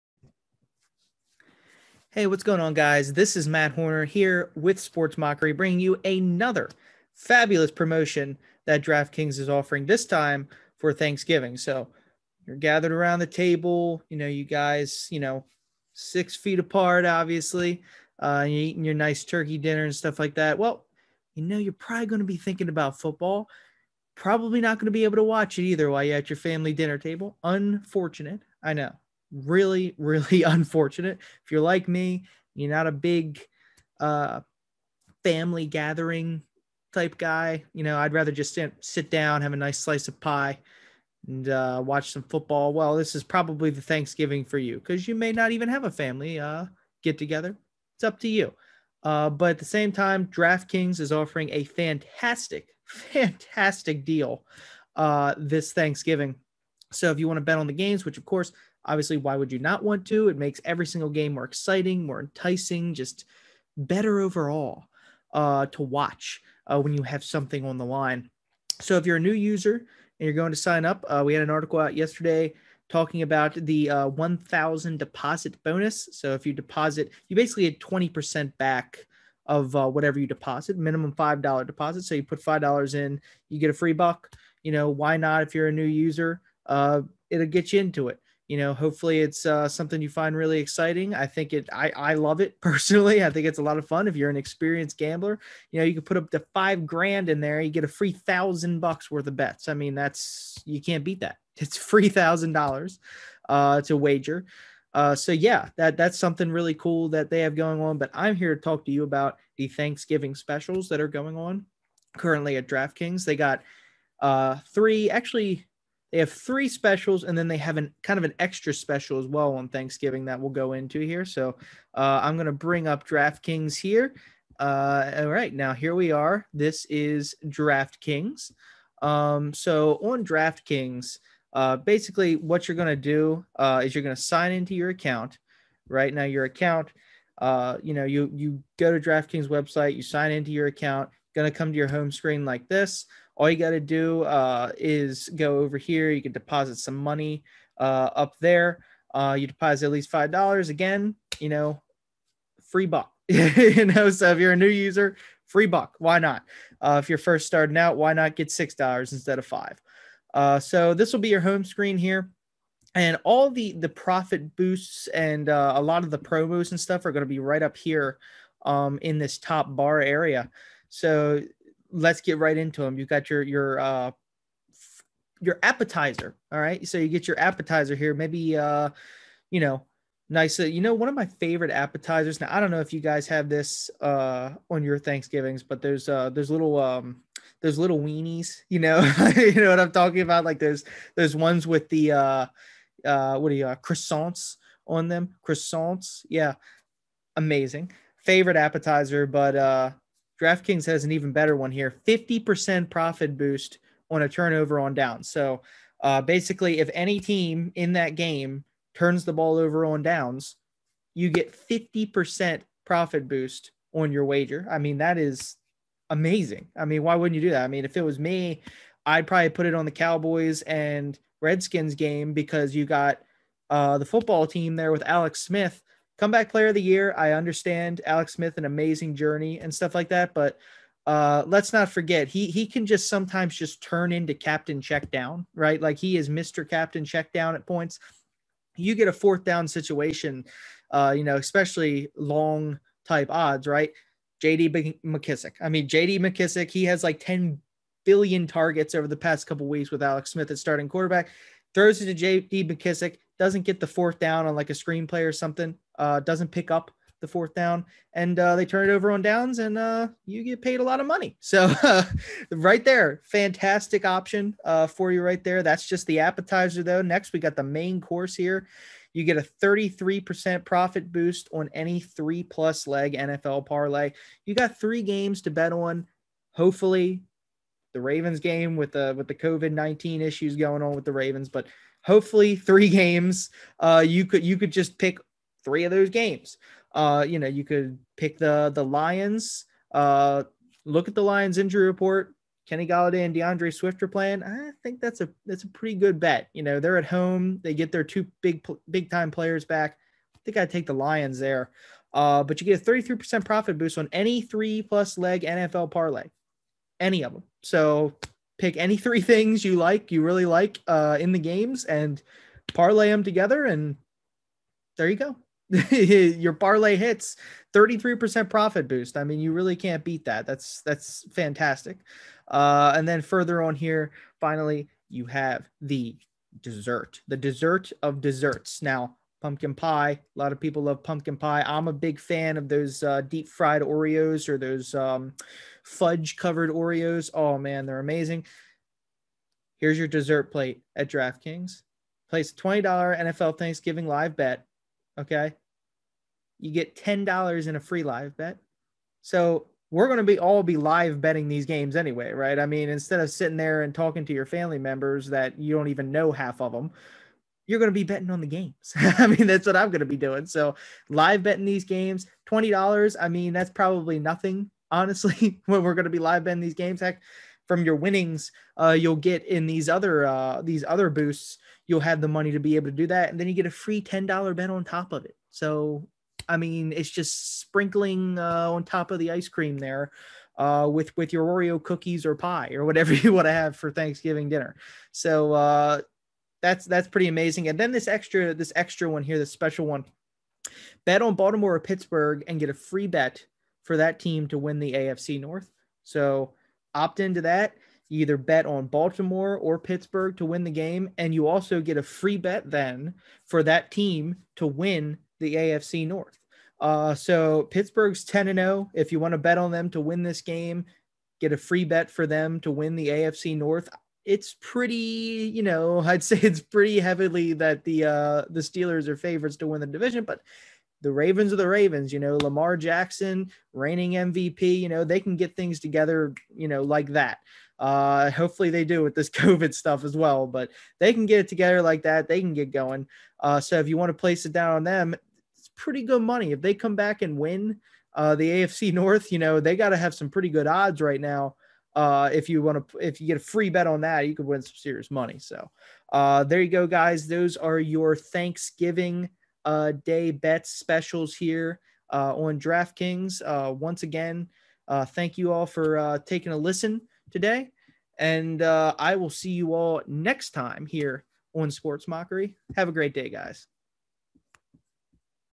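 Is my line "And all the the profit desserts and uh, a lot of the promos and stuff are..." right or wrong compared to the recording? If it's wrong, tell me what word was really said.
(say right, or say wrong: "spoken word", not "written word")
wrong: "boosts", not "desserts".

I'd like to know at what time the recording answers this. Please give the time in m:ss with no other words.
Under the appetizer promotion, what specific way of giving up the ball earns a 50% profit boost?
3:24.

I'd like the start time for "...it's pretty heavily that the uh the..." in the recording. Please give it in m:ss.
6:56.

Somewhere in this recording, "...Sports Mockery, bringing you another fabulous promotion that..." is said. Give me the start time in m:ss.
0:04.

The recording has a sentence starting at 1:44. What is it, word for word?
Uh, so yeah, that that's something really cool that they have going on.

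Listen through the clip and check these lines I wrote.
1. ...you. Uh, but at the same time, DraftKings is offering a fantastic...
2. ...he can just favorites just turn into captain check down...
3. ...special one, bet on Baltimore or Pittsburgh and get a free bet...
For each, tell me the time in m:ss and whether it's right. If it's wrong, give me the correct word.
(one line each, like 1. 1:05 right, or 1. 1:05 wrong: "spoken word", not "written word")
1. 0:48 right
2. 3:52 wrong: "sometimes", not "favorites"
3. 6:29 right.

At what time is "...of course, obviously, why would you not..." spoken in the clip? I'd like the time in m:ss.
0:58.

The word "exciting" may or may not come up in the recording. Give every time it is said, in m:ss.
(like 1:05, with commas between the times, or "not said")
1:01, 1:30.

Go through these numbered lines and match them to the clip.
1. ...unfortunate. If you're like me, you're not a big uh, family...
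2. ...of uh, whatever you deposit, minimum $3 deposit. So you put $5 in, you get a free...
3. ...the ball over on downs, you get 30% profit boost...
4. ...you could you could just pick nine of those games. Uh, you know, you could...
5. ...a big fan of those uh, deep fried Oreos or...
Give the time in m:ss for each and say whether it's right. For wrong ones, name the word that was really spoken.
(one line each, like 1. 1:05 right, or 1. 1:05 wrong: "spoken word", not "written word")
1. 0:30 right
2. 1:19 wrong: "5", not "3"
3. 3:29 wrong: "50", not "30"
4. 4:44 wrong: "three", not "nine"
5. 5:31 right.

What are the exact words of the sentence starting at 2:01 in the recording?
So uh, I'm going to bring up DraftKings here.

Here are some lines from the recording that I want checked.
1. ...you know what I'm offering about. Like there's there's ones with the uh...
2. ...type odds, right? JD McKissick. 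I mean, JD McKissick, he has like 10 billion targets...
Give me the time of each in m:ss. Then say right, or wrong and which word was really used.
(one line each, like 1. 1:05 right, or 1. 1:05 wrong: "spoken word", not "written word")
1. 3:09 wrong: "talking", not "offering"
2. 4:03 right.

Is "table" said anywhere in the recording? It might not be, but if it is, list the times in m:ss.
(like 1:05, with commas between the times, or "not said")
0:13, 0:26.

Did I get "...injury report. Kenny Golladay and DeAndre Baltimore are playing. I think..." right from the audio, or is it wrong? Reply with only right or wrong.
wrong.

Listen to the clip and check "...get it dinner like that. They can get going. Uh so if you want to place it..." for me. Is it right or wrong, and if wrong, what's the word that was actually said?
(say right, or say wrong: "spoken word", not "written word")
wrong: "together", not "dinner".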